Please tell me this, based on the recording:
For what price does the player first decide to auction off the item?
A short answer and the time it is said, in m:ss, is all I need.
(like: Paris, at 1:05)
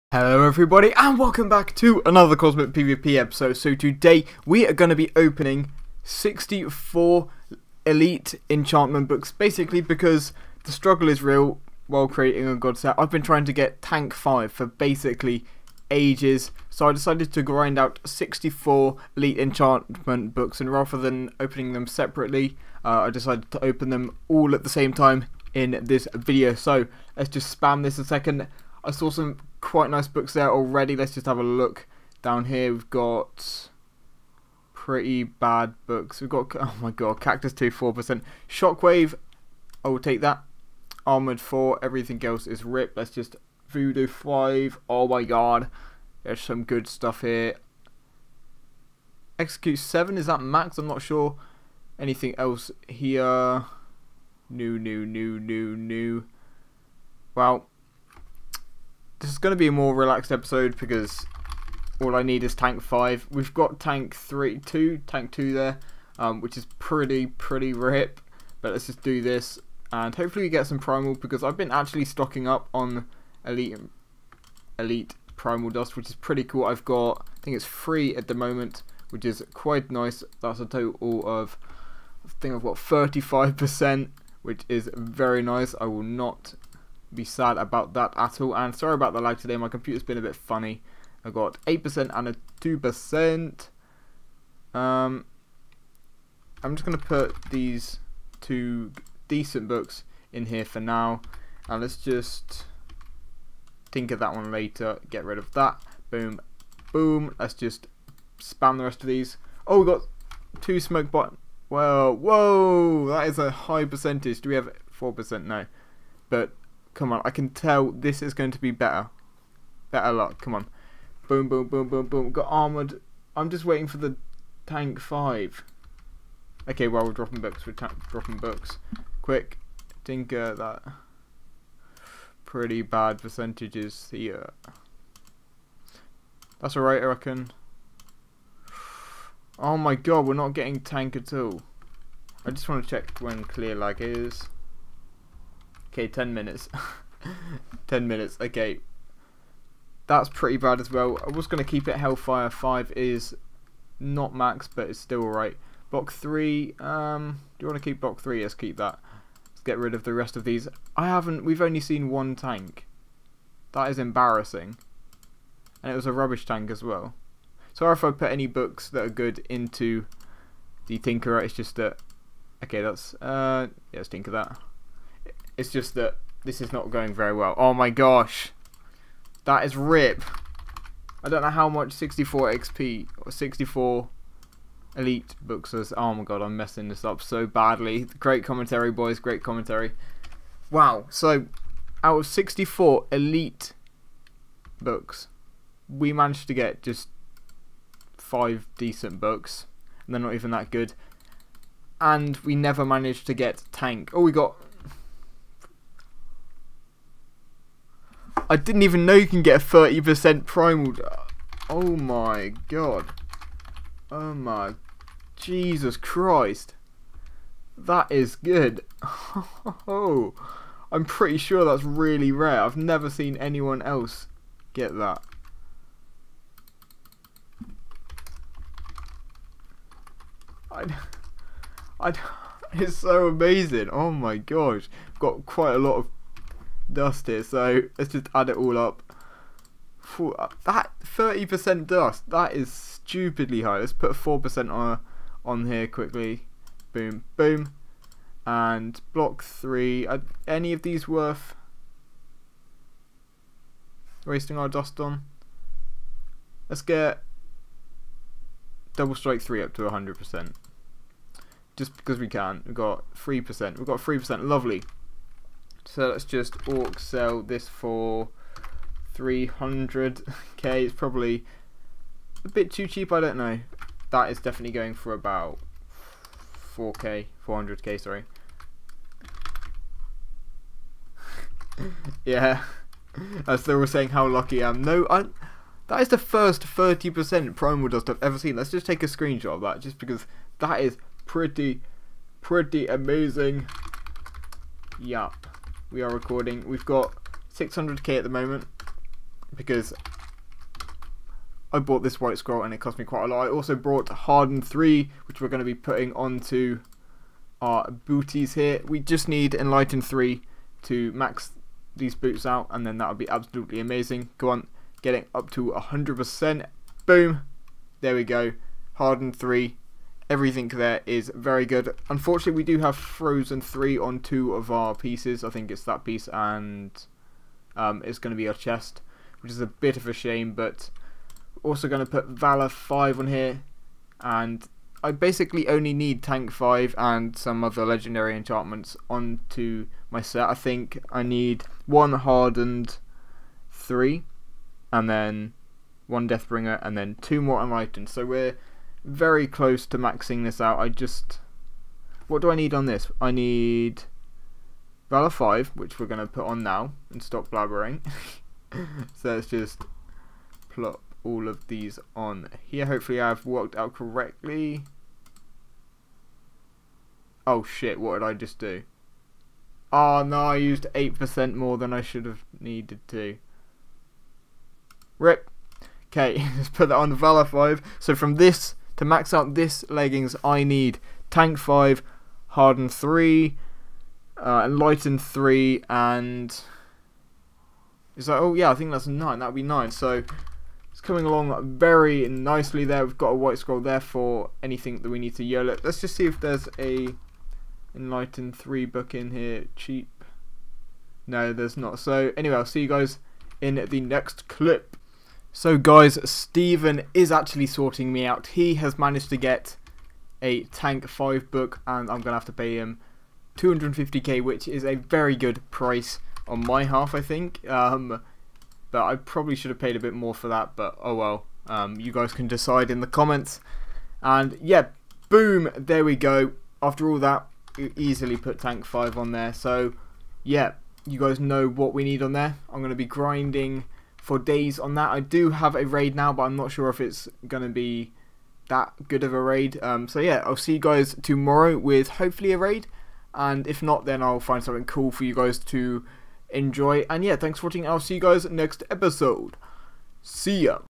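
300k, at 4:29.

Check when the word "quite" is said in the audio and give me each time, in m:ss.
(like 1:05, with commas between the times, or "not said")
0:29, 1:19, 3:55, 5:03.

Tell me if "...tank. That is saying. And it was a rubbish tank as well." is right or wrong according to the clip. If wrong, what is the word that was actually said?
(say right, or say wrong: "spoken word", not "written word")
wrong: "embarrassing", not "saying".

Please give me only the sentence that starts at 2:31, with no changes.
I was going to keep it Hellfire.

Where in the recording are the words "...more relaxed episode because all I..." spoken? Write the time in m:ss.
0:59.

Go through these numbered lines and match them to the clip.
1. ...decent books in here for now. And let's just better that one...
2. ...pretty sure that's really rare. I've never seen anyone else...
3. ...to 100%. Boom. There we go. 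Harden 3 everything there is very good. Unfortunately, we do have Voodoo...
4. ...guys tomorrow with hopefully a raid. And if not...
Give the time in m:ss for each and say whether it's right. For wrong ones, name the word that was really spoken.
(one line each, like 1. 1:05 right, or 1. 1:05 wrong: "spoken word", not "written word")
1. 1:39 wrong: "tinker", not "better"
2. 3:41 right
3. 5:15 wrong: "Frozen", not "Voodoo"
4. 7:20 right.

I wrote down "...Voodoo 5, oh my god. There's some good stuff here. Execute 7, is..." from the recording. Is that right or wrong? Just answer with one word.
right.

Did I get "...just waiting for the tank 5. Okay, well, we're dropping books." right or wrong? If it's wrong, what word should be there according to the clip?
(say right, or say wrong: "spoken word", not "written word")
right.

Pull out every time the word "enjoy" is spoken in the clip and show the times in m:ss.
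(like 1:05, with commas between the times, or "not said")
7:26.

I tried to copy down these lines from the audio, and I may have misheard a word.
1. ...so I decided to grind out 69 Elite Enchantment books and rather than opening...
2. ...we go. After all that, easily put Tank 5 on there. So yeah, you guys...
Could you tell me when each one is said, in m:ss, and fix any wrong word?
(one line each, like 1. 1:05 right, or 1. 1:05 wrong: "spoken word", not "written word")
1. 0:16 wrong: "64", not "69"
2. 7:06 right.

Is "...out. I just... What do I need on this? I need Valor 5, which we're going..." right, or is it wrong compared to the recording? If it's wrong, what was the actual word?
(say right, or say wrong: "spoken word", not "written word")
right.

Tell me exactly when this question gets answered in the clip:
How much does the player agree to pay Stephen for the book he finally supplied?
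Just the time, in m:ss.
6:53.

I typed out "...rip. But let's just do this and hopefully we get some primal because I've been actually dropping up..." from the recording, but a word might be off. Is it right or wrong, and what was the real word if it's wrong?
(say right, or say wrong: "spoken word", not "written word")
wrong: "stocking", not "dropping".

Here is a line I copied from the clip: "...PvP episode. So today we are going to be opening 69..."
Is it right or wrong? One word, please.
wrong.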